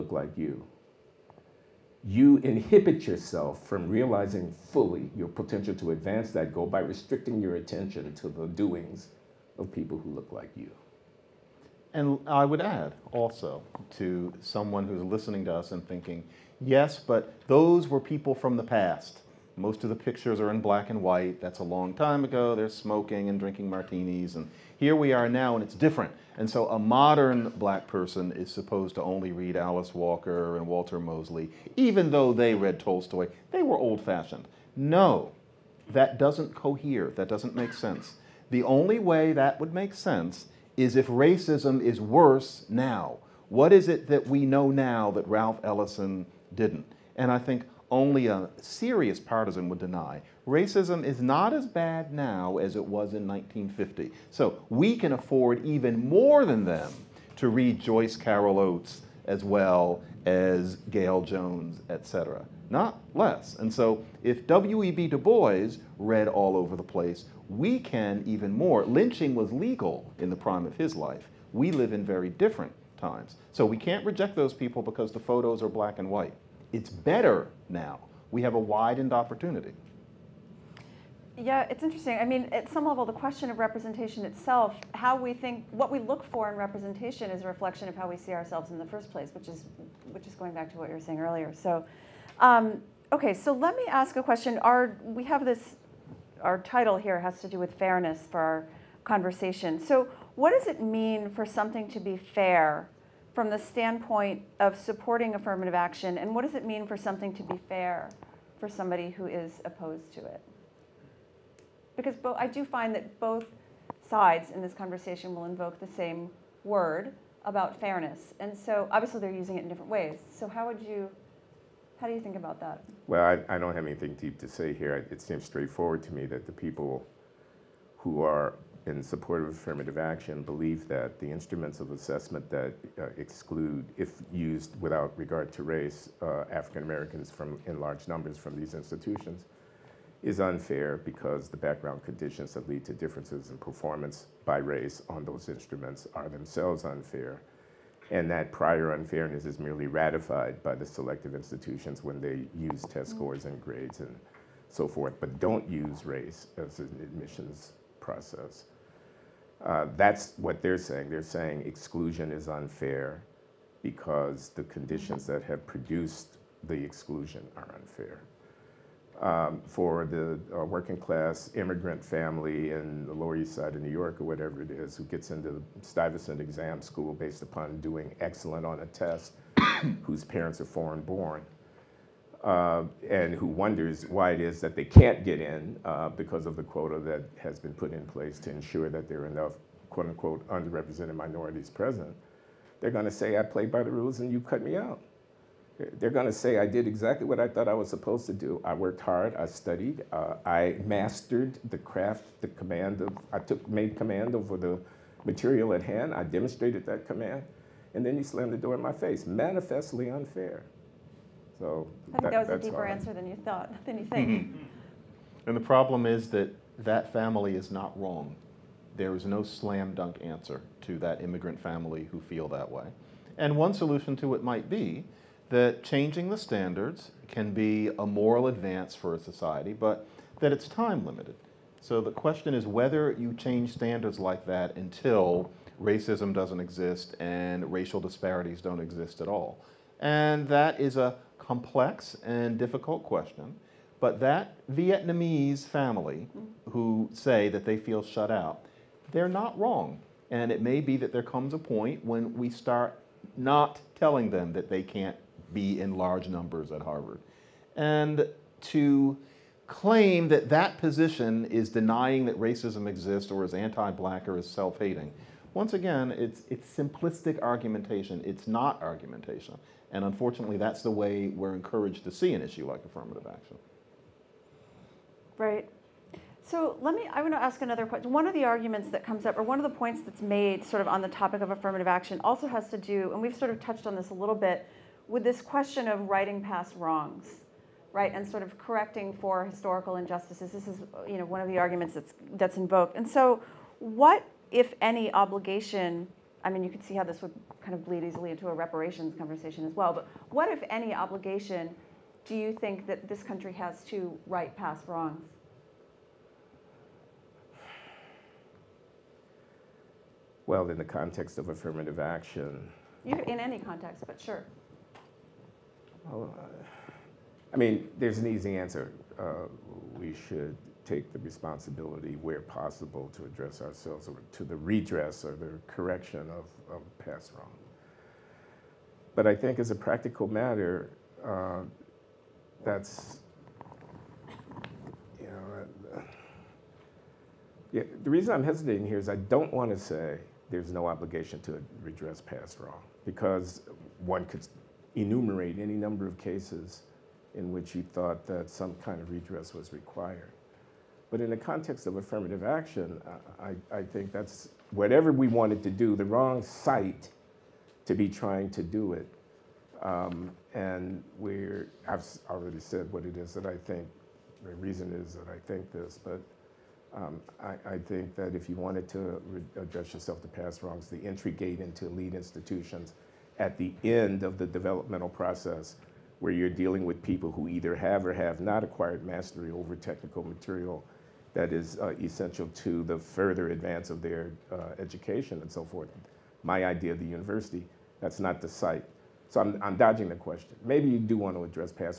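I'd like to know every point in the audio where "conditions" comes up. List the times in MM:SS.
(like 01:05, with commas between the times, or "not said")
02:22, 02:44.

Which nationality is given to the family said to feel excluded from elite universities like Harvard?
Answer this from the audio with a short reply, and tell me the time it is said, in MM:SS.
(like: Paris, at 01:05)
Vietnamese, at 04:04.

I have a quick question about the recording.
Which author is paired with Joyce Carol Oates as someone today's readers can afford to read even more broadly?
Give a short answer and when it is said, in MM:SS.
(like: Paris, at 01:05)
Gayl Jones, at 01:00.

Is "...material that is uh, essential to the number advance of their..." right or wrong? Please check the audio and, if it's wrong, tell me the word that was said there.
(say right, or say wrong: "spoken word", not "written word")
wrong: "further", not "number".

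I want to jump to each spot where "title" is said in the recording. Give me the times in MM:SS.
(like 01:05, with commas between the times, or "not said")
01:36.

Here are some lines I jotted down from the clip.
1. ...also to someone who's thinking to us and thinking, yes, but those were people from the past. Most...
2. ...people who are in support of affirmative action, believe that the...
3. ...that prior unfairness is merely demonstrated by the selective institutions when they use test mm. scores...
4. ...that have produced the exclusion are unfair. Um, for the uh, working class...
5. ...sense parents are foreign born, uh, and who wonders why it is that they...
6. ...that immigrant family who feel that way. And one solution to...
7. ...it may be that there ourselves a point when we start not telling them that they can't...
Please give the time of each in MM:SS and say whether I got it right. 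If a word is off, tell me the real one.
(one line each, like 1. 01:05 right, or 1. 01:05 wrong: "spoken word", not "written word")
1. 00:13 wrong: "listening", not "thinking"
2. 02:06 right
3. 02:28 wrong: "ratified", not "demonstrated"
4. 02:45 right
5. 03:00 wrong: "whose", not "sense"
6. 03:40 right
7. 04:10 wrong: "comes", not "ourselves".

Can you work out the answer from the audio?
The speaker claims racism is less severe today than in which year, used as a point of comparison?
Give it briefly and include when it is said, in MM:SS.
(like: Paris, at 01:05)
1950, at 00:53.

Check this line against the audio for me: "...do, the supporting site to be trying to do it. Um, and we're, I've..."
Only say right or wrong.
wrong.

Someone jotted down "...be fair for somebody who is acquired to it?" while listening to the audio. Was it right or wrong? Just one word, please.
wrong.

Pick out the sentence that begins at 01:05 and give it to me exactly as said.
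Du Bois read all over the place, we can even more.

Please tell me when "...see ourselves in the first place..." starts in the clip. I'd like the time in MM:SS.
01:28.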